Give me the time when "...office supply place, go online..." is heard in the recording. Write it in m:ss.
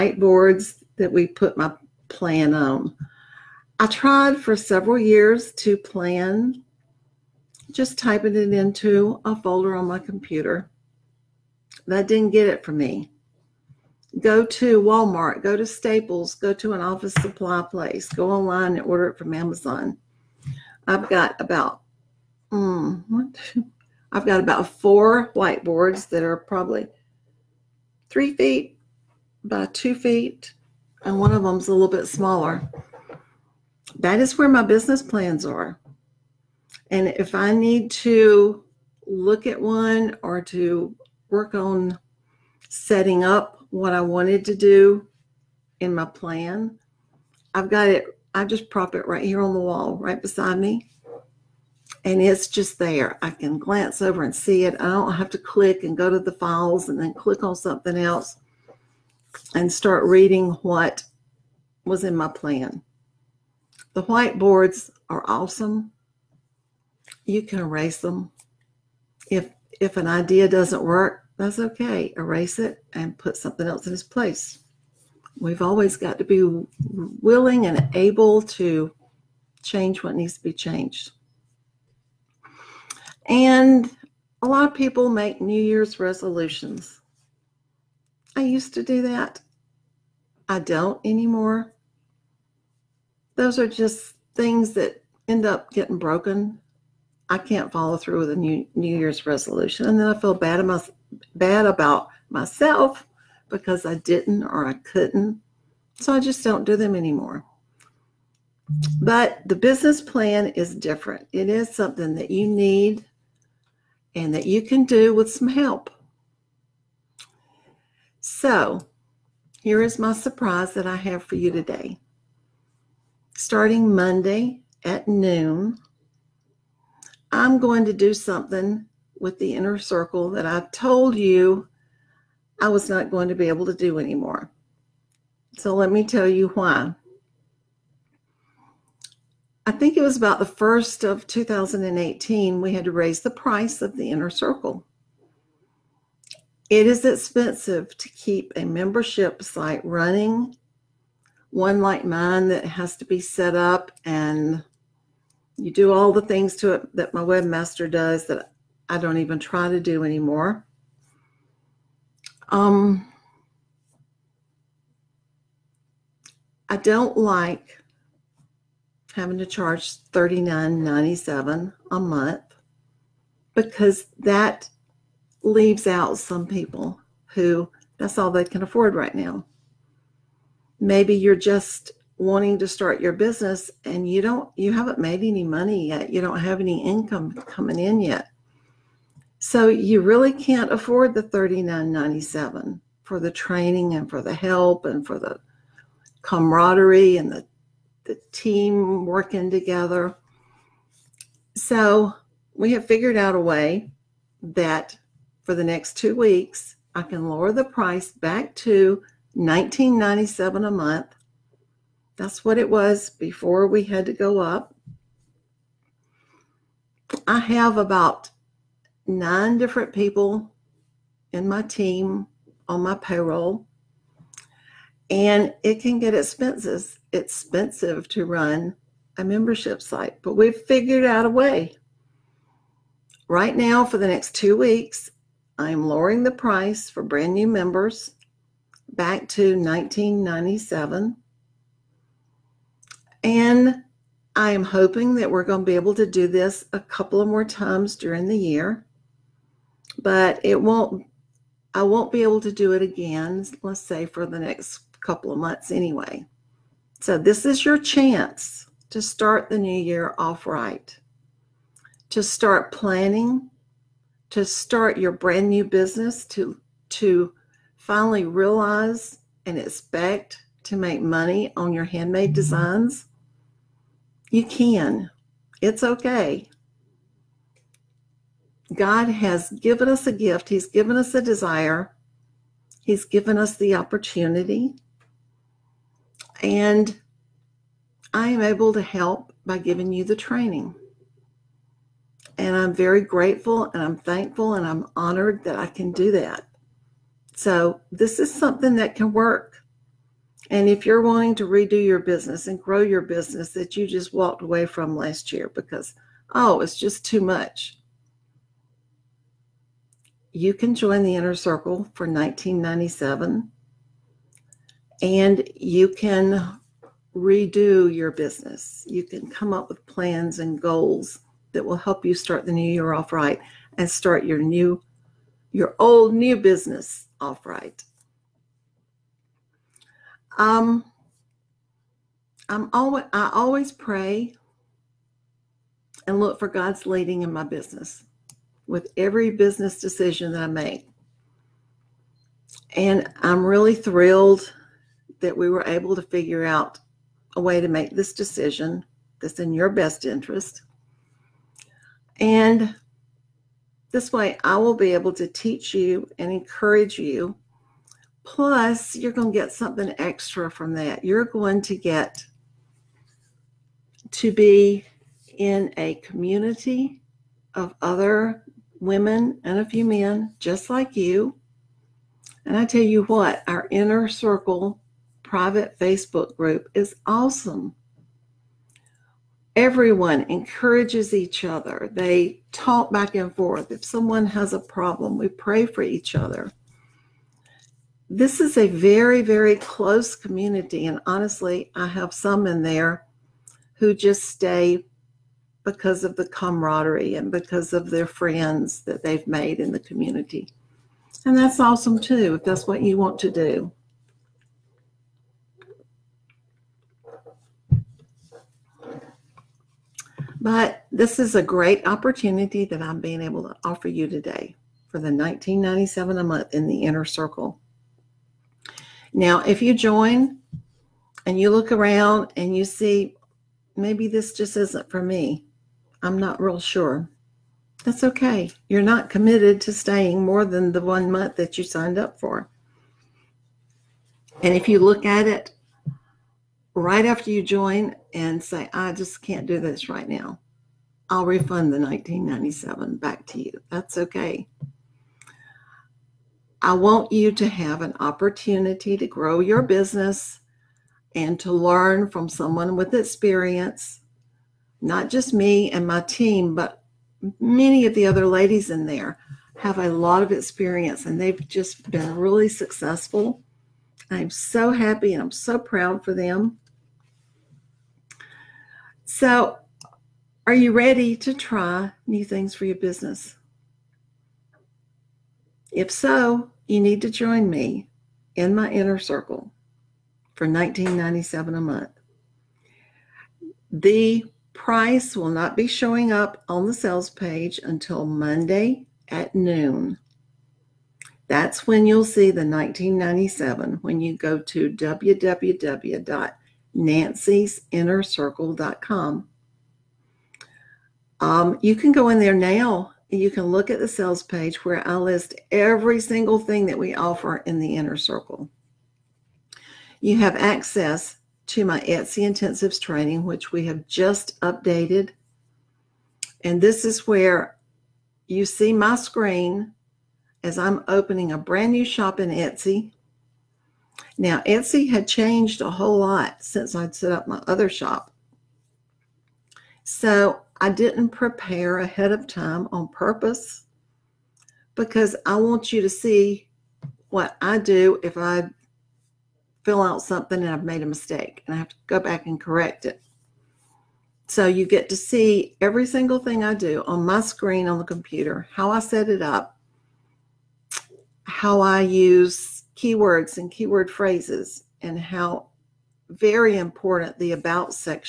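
0:16.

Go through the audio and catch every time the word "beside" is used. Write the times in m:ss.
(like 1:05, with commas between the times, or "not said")
0:50.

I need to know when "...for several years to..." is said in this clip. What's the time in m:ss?
0:04.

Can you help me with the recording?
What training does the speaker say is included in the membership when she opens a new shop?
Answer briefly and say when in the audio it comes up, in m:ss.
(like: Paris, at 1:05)
Etsy Intensives, at 8:31.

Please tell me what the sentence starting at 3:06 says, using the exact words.
You don't have any income coming in yet.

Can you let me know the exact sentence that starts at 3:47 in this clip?
It's expensive to run a membership site, but we've figured out a way.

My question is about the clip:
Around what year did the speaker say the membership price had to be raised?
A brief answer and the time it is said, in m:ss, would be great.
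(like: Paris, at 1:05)
2018, at 2:21.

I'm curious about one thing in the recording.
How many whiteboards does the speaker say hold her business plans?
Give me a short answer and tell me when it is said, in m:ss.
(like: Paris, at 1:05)
4, at 0:24.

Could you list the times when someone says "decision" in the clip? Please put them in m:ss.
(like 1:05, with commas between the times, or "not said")
5:39, 5:48.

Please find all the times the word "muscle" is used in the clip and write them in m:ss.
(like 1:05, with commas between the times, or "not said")
not said.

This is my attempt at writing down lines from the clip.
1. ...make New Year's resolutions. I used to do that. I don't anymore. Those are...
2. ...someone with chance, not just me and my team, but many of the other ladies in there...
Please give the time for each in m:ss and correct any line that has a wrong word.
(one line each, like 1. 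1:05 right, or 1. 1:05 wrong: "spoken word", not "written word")
1. 1:25 right
2. 7:32 wrong: "experience", not "chance".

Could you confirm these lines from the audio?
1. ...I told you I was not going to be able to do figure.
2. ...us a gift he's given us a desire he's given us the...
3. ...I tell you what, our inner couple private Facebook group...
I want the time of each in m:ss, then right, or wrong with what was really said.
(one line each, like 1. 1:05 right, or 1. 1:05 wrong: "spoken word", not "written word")
1. 2:10 wrong: "anymore", not "figure"
2. 4:39 right
3. 6:12 wrong: "circle", not "couple".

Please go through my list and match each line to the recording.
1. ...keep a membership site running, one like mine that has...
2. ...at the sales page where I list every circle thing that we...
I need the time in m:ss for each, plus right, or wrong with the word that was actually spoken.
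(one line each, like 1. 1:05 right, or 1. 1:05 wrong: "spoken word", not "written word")
1. 2:28 right
2. 8:23 wrong: "single", not "circle".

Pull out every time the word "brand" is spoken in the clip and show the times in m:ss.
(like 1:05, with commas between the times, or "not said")
3:57, 4:25, 8:41.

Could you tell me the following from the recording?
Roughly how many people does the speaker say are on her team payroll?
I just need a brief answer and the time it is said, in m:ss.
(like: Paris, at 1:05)
9, at 3:39.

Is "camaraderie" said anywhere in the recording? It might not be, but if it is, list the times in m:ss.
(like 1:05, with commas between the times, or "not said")
3:16, 6:36.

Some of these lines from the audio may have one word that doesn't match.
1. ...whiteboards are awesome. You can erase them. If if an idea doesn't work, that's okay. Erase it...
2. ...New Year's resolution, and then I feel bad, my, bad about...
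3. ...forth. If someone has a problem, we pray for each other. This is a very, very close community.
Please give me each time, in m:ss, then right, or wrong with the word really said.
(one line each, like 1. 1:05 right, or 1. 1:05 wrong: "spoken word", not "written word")
1. 1:04 right
2. 1:38 right
3. 6:23 right.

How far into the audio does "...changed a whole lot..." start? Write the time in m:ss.
8:45.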